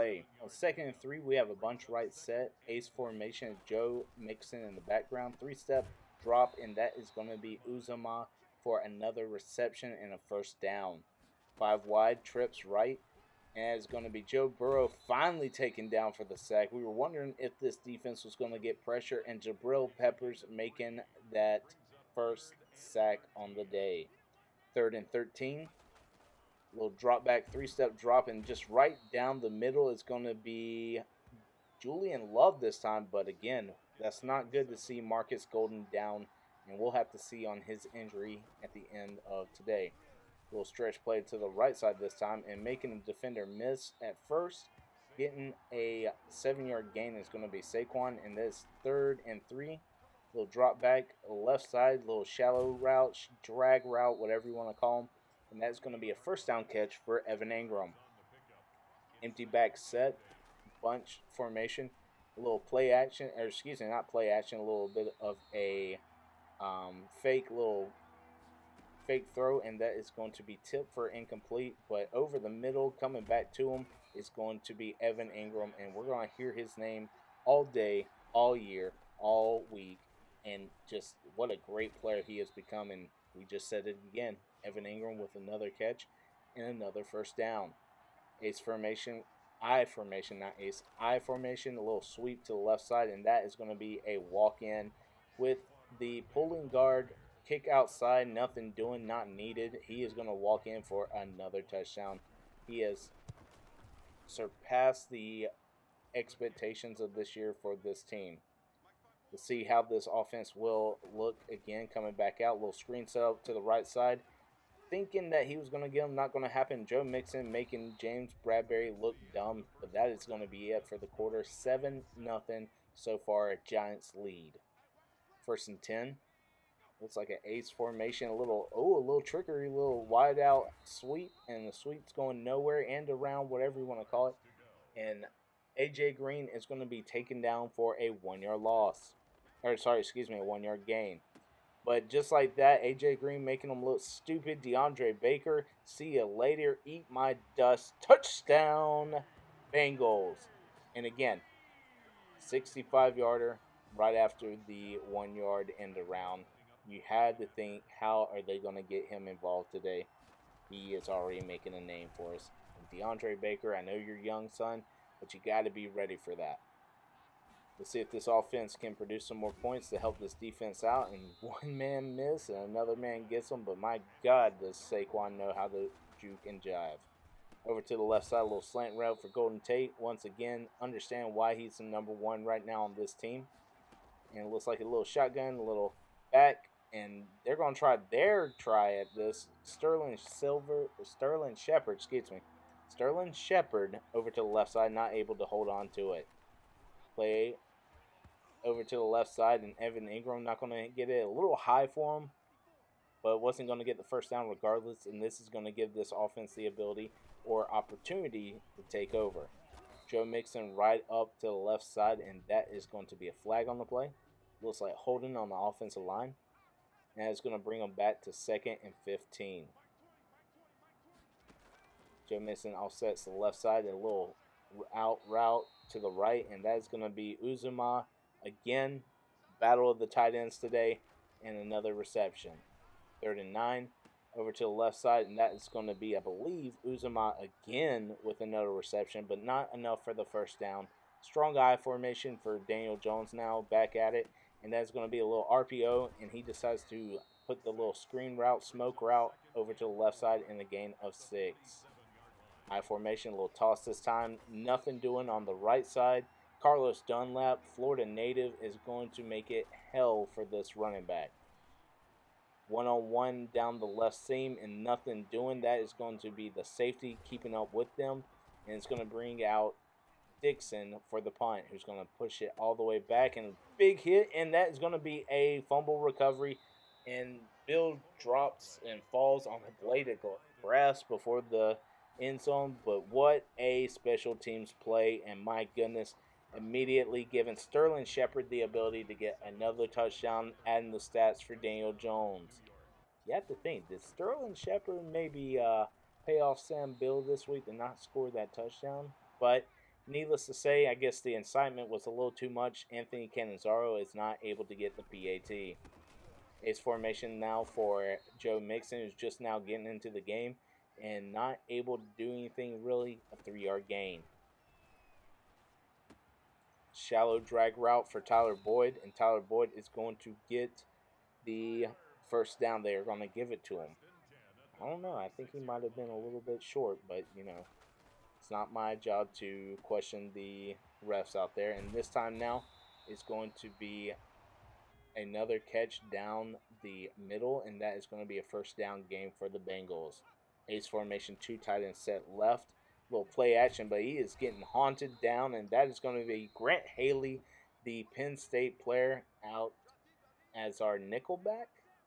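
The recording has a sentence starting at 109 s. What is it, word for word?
We'll see how this offense will look again coming back out.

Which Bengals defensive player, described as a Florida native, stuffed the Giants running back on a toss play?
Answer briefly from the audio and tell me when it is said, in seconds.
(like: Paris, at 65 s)
Carlos Dunlap, at 256 s.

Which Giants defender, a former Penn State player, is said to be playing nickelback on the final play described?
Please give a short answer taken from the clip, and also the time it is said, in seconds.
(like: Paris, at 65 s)
Grant Haley, at 346 s.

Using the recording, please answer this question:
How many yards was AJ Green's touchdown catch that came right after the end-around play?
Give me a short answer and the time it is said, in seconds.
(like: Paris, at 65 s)
65, at 152 s.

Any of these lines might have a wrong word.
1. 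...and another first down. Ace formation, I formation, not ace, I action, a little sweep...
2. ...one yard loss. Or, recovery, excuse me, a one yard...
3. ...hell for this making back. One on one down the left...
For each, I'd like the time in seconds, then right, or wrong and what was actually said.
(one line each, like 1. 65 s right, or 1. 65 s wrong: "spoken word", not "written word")
1. 86 s wrong: "formation", not "action"
2. 138 s wrong: "sorry", not "recovery"
3. 259 s wrong: "running", not "making".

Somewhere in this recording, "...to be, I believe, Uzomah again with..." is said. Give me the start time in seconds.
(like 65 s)
235 s.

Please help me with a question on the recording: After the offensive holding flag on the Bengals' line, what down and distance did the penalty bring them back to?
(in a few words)
second and 15.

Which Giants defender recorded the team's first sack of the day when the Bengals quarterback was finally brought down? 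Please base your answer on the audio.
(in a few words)
Jabril Peppers.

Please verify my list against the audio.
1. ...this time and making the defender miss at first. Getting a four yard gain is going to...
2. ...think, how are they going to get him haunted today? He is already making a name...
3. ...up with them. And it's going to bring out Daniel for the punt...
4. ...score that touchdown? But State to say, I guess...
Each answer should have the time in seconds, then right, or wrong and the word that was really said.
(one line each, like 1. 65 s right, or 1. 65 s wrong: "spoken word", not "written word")
1. 41 s wrong: "seven", not "four"
2. 157 s wrong: "involved", not "haunted"
3. 267 s wrong: "Dixon", not "Daniel"
4. 298 s wrong: "Needless", not "State".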